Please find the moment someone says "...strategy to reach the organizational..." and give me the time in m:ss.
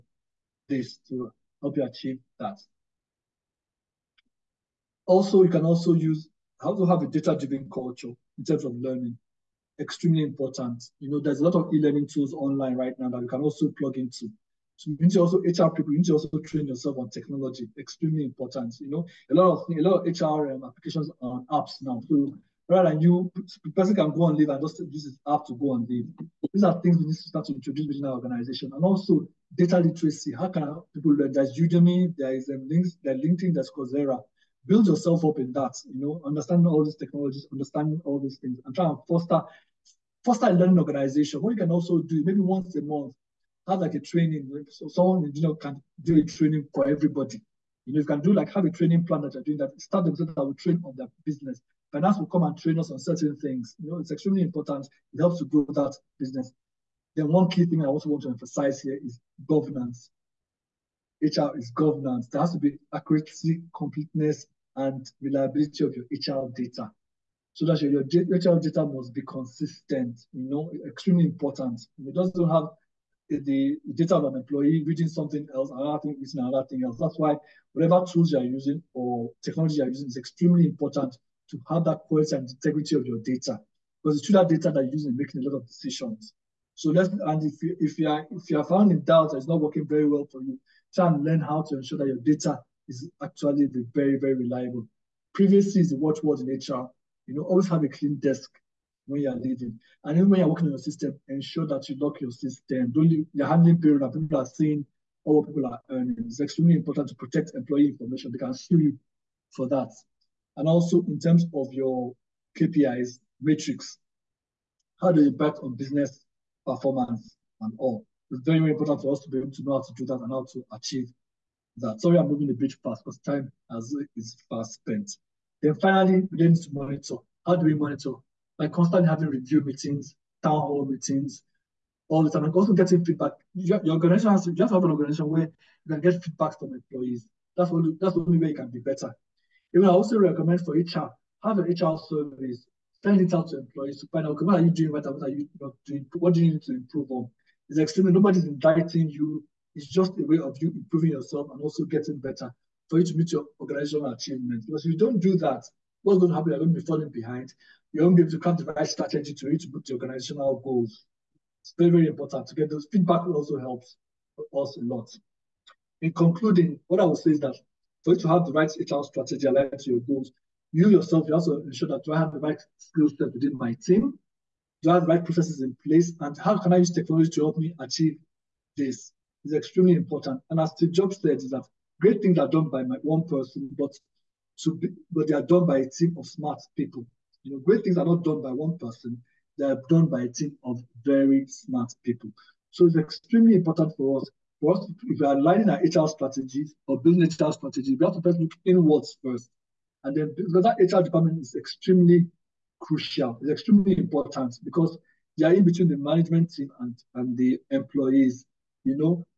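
2:38.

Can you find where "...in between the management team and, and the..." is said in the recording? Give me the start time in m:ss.
3:25.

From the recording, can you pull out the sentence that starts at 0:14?
So you need to also HR people, you need to also train yourself on technology.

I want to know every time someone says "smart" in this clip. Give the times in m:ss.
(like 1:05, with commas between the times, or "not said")
3:06, 3:11.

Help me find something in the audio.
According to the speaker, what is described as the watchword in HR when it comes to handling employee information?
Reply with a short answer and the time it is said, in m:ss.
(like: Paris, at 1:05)
Privacy, at 1:35.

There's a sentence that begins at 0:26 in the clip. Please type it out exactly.
These are things we need to start to introduce within our organization, and also data literacy.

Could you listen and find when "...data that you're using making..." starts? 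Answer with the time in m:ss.
1:24.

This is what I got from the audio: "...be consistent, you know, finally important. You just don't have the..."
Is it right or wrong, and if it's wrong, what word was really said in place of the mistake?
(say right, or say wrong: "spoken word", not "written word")
wrong: "extremely", not "finally".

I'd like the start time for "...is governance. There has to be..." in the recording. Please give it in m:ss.
1:01.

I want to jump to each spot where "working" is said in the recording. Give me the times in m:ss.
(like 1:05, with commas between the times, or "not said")
1:29, 1:40.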